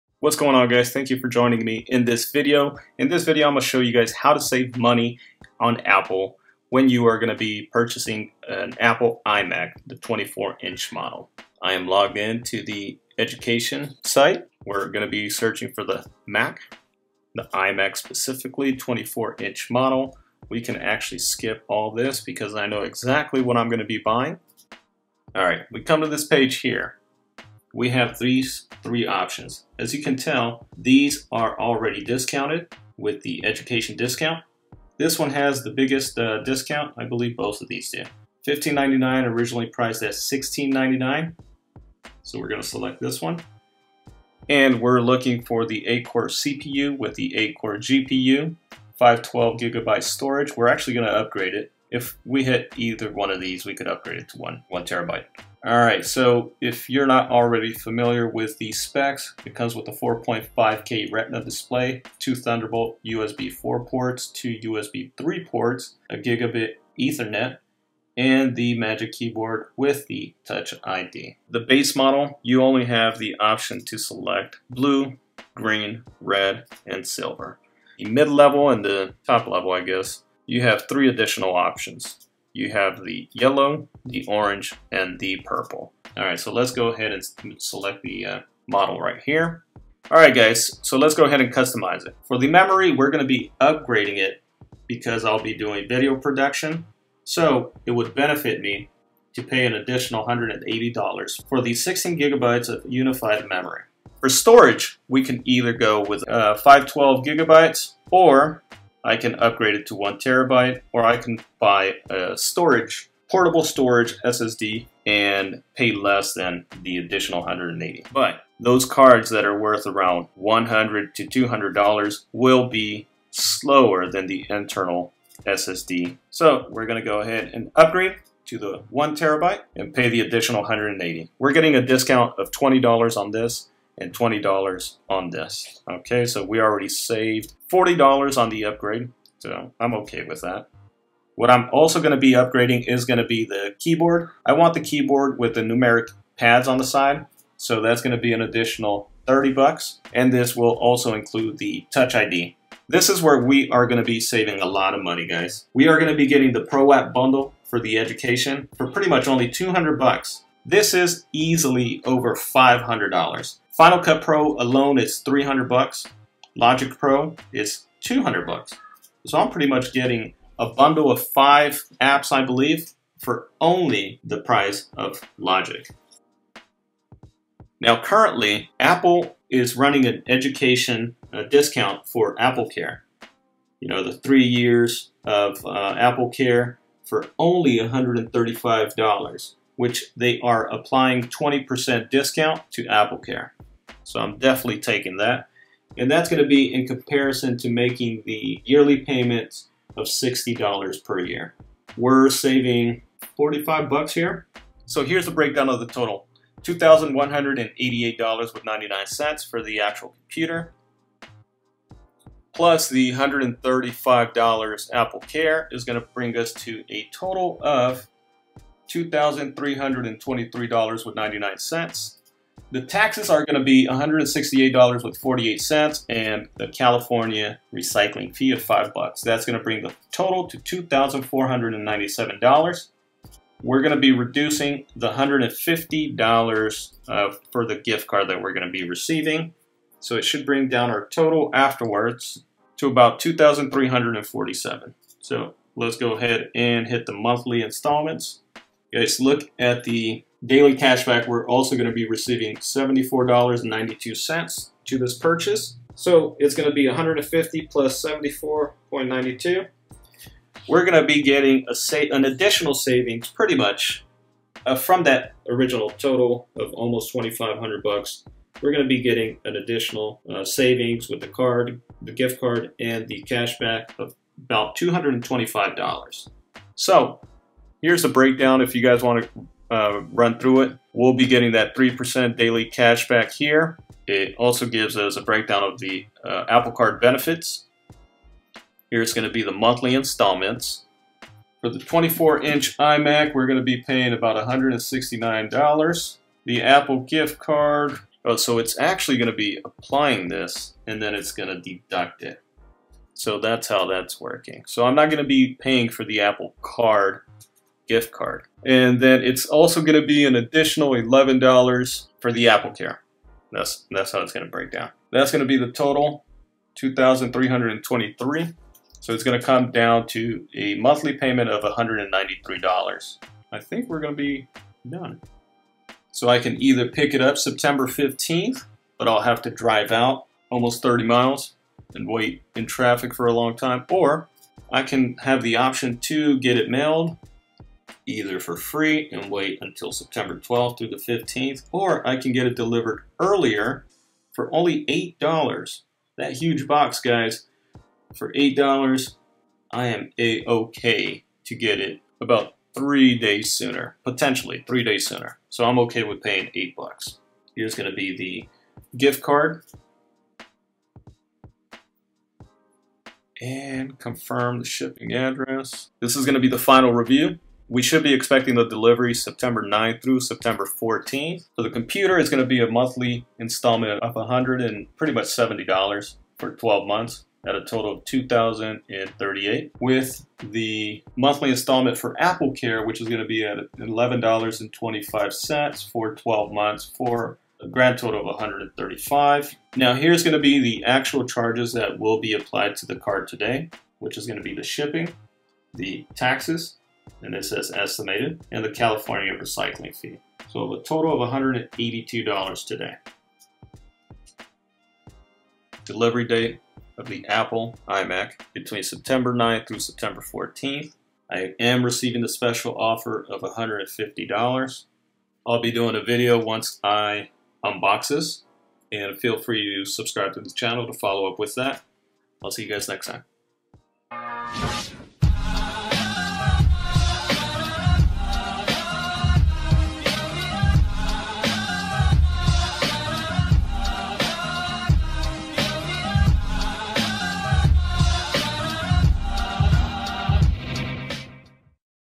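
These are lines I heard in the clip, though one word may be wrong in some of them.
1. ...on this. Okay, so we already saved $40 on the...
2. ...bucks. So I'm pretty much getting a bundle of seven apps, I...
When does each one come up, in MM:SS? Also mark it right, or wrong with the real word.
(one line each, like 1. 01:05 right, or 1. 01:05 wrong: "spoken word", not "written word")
1. 02:15 right
2. 02:48 wrong: "five", not "seven".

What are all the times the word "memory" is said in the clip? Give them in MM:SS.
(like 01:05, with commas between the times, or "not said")
01:32, 01:43.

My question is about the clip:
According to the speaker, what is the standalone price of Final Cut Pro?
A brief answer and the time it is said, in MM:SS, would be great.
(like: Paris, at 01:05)
$300, at 02:45.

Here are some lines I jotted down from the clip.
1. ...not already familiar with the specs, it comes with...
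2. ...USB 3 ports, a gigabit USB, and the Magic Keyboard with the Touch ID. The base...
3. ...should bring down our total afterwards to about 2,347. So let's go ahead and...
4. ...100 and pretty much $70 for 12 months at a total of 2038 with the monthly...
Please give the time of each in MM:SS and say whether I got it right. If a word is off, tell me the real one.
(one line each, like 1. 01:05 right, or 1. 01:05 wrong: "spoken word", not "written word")
1. 00:57 right
2. 01:04 wrong: "Ethernet", not "USB"
3. 04:00 right
4. 06:14 right.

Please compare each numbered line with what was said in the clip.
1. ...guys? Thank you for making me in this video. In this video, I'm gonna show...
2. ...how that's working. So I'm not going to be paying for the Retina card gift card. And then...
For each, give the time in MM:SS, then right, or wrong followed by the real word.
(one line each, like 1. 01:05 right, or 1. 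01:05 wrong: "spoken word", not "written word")
1. 00:00 wrong: "joining", not "making"
2. 05:03 wrong: "Apple", not "Retina".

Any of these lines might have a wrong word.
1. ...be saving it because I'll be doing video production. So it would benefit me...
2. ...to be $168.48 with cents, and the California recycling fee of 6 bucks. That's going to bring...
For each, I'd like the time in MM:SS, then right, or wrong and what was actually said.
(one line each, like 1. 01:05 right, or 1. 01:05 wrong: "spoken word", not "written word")
1. 01:33 wrong: "upgrading", not "saving"
2. 03:43 wrong: "5", not "6".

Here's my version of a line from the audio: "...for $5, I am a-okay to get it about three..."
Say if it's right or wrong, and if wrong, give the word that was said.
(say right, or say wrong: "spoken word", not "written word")
wrong: "8", not "5".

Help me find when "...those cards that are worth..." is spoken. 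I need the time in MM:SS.
01:58.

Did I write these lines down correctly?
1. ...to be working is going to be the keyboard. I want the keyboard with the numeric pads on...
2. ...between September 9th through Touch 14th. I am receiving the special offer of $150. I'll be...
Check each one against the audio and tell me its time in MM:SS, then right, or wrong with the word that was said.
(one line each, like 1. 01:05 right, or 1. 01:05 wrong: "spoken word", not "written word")
1. 02:22 wrong: "upgrading", not "working"
2. 06:48 wrong: "September", not "Touch".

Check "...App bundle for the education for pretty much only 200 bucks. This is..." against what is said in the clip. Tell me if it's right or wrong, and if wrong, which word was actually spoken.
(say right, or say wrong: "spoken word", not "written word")
right.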